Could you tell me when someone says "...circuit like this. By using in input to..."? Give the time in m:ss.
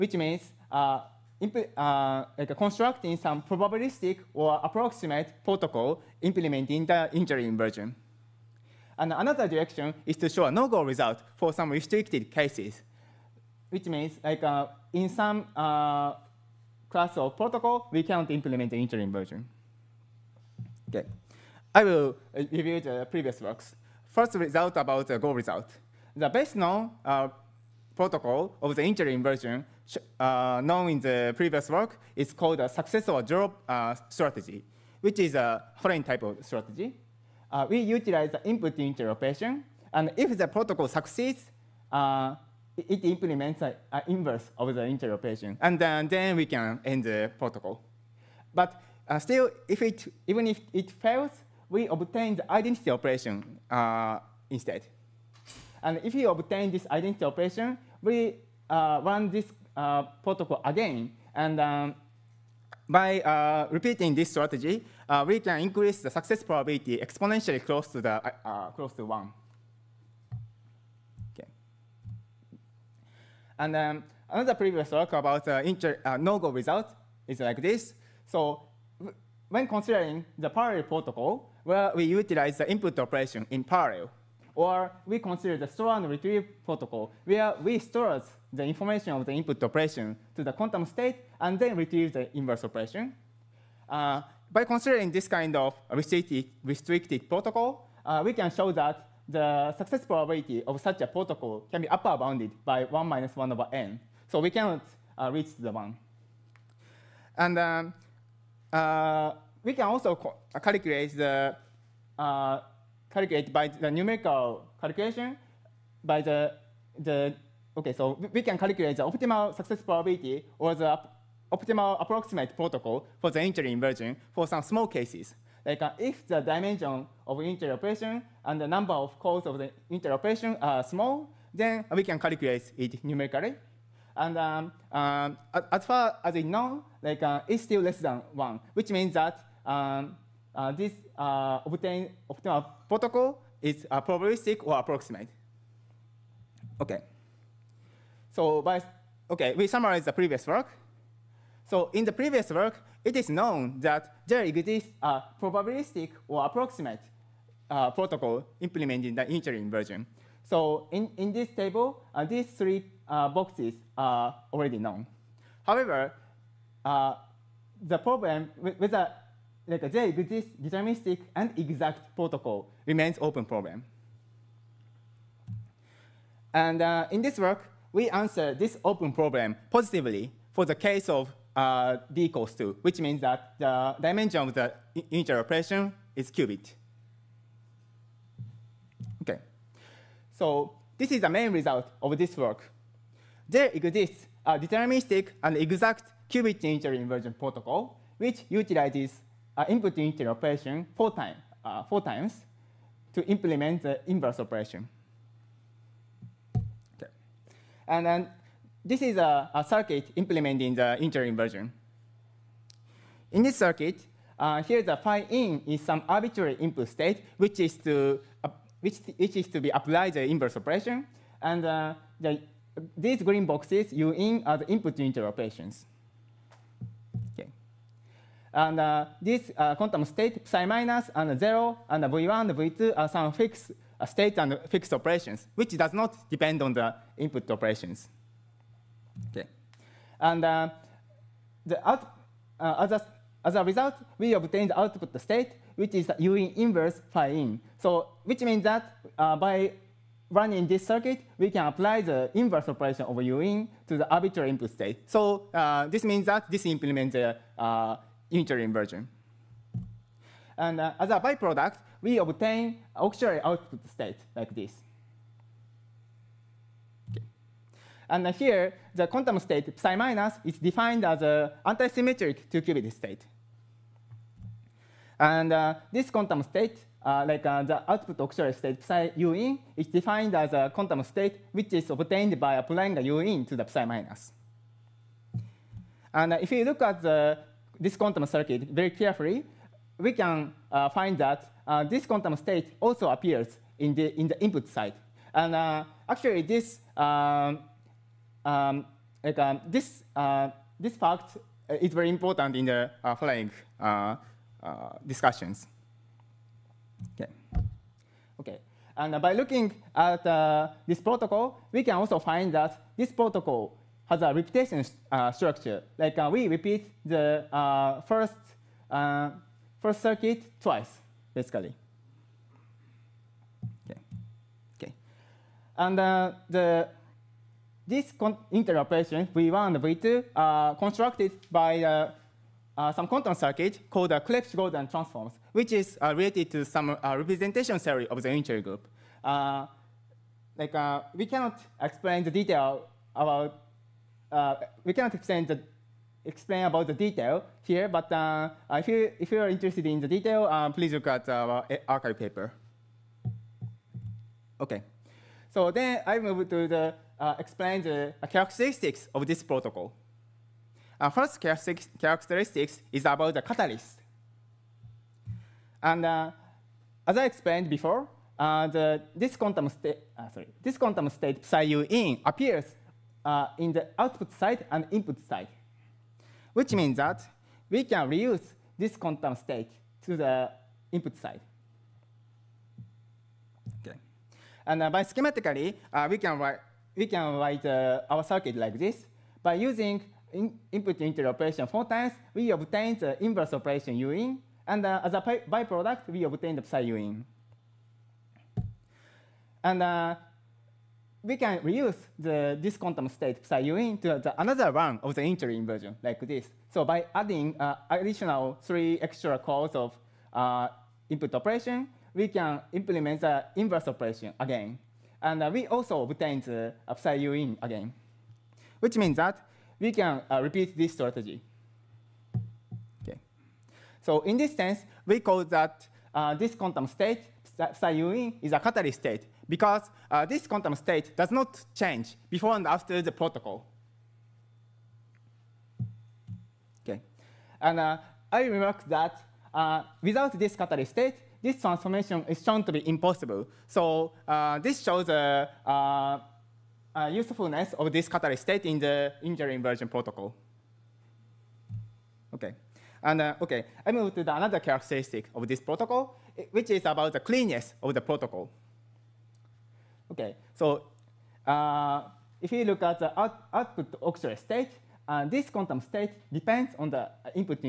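6:28.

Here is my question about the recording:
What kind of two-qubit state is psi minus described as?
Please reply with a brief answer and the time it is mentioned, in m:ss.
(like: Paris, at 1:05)
antisymmetric, at 4:31.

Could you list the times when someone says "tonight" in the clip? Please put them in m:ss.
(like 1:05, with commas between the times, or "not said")
not said.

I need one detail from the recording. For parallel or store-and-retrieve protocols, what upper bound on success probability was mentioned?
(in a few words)
1 minus 1 over n.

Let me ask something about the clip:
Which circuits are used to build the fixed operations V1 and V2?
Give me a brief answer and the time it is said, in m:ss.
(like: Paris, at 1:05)
Clebsch-Gordan transforms, at 5:34.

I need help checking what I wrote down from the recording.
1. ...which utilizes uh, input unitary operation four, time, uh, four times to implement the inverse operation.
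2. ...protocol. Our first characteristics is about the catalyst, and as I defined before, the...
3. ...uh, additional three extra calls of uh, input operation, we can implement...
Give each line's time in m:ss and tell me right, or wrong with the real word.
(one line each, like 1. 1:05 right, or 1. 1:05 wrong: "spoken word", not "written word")
1. 3:18 right
2. 5:59 wrong: "explained", not "defined"
3. 6:47 right.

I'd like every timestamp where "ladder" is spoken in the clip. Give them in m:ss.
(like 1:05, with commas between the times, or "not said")
not said.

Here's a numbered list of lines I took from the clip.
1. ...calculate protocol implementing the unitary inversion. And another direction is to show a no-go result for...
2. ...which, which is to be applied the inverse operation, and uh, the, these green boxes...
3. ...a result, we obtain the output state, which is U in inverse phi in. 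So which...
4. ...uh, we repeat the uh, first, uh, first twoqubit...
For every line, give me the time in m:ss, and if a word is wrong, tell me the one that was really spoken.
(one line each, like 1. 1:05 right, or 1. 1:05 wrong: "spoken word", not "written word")
1. 0:04 wrong: "approximate", not "calculate"
2. 3:38 right
3. 4:03 right
4. 5:16 wrong: "circuit", not "twoqubit".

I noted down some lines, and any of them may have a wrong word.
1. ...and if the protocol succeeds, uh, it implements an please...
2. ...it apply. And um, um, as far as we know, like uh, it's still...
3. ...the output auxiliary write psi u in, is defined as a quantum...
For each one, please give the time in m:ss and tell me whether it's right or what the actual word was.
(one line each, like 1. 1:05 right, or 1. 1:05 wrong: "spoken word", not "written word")
1. 0:39 wrong: "inverse", not "please"
2. 2:12 wrong: "numerically", not "apply"
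3. 4:37 wrong: "state", not "write".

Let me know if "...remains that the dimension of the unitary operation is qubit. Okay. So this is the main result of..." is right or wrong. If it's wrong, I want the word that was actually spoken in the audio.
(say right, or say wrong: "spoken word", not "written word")
wrong: "means", not "remains".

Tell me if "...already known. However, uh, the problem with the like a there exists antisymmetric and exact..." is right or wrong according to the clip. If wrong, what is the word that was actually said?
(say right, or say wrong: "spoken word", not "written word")
wrong: "deterministic", not "antisymmetric".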